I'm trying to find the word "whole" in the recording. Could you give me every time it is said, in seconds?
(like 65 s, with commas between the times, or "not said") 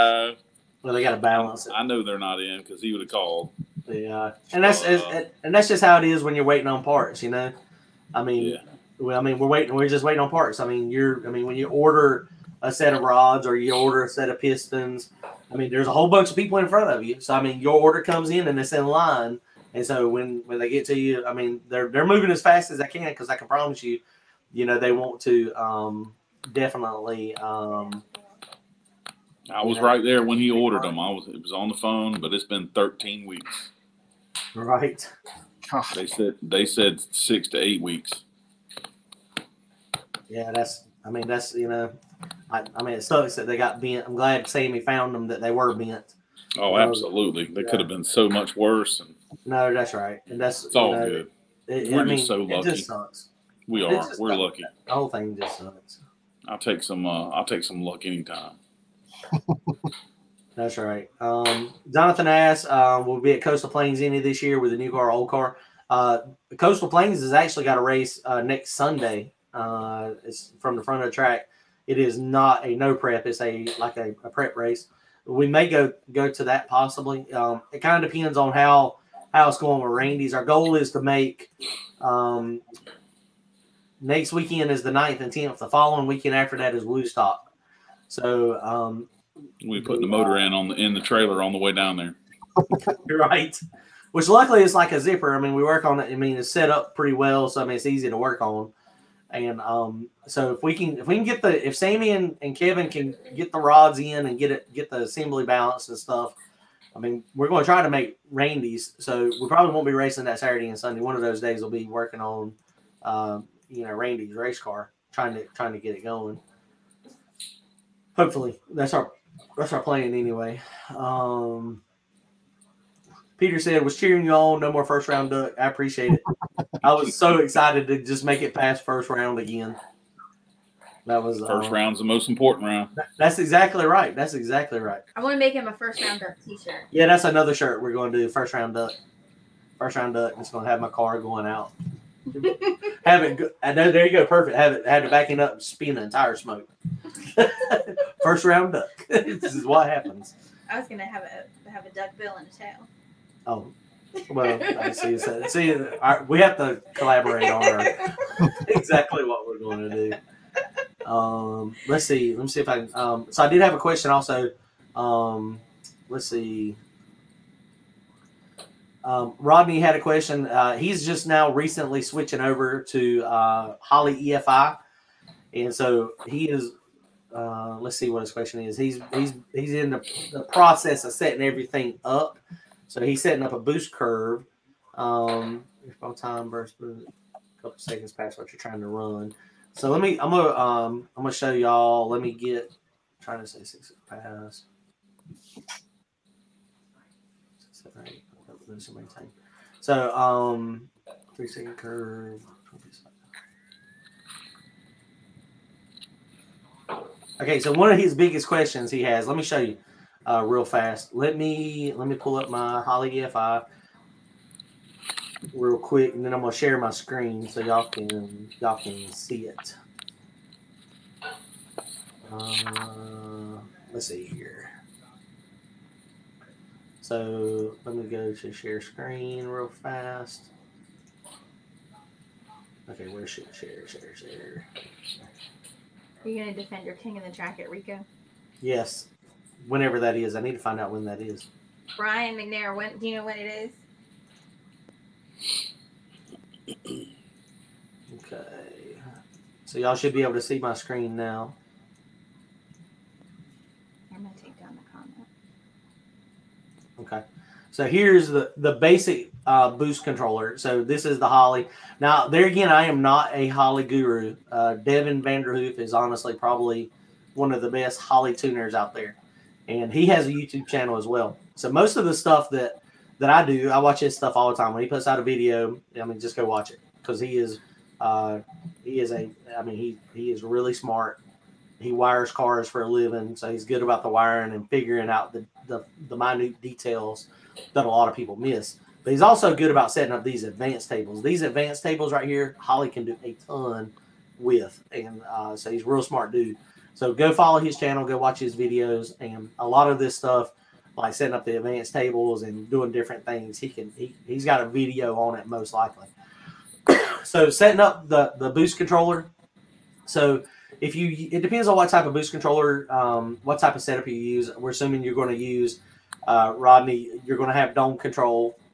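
15 s, 54 s.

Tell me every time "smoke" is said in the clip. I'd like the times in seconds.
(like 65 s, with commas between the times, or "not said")
146 s.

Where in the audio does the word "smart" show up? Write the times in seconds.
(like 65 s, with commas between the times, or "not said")
280 s, 296 s.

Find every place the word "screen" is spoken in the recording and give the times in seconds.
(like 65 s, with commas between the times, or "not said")
216 s, 228 s, 250 s.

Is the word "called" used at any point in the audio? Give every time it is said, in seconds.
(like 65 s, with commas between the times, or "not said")
3 s.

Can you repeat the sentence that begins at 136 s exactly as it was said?
Yeah, that's another shirt we're going to do.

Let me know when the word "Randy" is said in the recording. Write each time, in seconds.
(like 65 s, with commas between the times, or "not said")
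79 s, 108 s, 113 s.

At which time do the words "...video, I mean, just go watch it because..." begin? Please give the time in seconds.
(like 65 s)
275 s.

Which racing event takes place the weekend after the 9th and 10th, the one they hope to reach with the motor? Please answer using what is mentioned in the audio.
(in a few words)
Woodstock.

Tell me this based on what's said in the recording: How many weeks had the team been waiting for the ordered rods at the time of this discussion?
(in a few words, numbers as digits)
13.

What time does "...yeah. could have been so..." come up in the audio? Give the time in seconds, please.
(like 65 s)
47 s.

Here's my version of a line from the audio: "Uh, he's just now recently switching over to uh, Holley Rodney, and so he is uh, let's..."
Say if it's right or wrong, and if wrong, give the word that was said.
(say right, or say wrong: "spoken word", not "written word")
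wrong: "EFI", not "Rodney".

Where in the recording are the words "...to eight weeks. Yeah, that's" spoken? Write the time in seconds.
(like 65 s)
37 s.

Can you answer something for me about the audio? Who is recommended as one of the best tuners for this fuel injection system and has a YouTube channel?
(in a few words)
Devin Vanderhoof.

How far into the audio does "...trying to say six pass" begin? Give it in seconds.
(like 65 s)
193 s.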